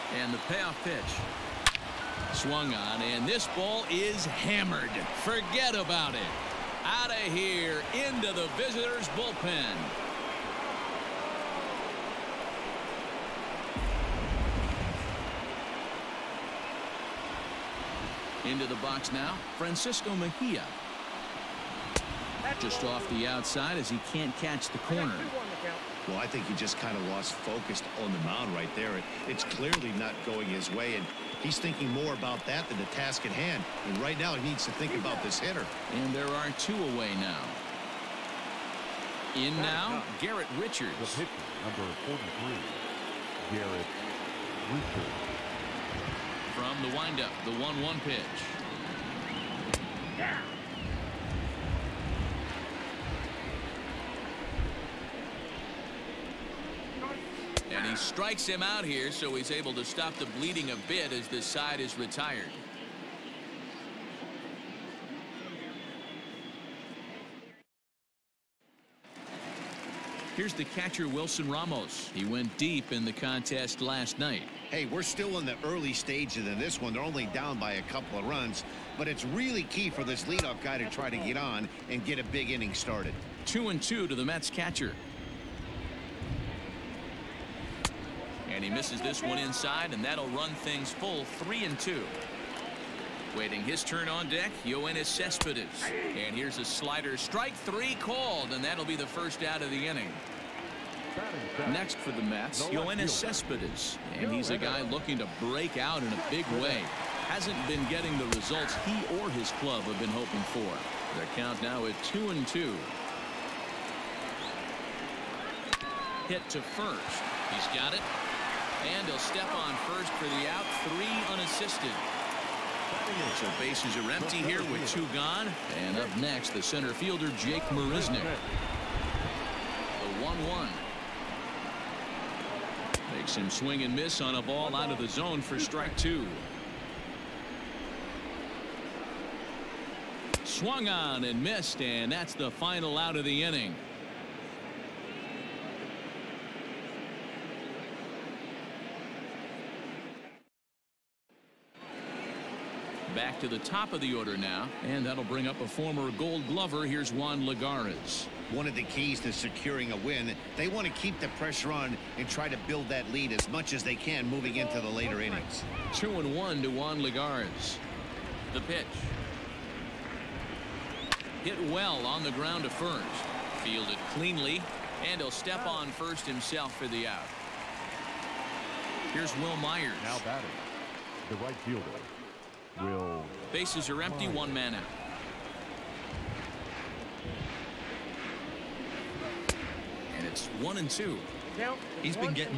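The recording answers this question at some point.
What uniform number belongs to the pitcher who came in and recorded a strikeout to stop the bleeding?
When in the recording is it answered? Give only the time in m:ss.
0:42.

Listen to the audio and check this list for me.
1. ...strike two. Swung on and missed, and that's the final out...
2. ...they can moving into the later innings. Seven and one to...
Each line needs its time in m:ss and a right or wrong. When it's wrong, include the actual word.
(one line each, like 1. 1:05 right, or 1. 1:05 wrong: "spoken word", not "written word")
1. 2:15 right
2. 2:43 wrong: "Two", not "Seven".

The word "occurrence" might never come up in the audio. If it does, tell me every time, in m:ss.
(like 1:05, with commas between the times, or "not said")
not said.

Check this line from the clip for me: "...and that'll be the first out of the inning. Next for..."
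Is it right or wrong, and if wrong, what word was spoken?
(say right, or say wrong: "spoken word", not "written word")
right.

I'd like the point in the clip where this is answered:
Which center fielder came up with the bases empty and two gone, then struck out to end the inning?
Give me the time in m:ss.
2:07.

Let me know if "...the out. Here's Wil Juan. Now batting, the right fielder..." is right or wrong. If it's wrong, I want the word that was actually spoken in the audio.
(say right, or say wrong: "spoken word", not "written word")
wrong: "Myers", not "Juan".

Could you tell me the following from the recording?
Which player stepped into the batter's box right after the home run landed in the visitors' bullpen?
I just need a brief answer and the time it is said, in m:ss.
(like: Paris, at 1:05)
Francisco Mejia, at 0:19.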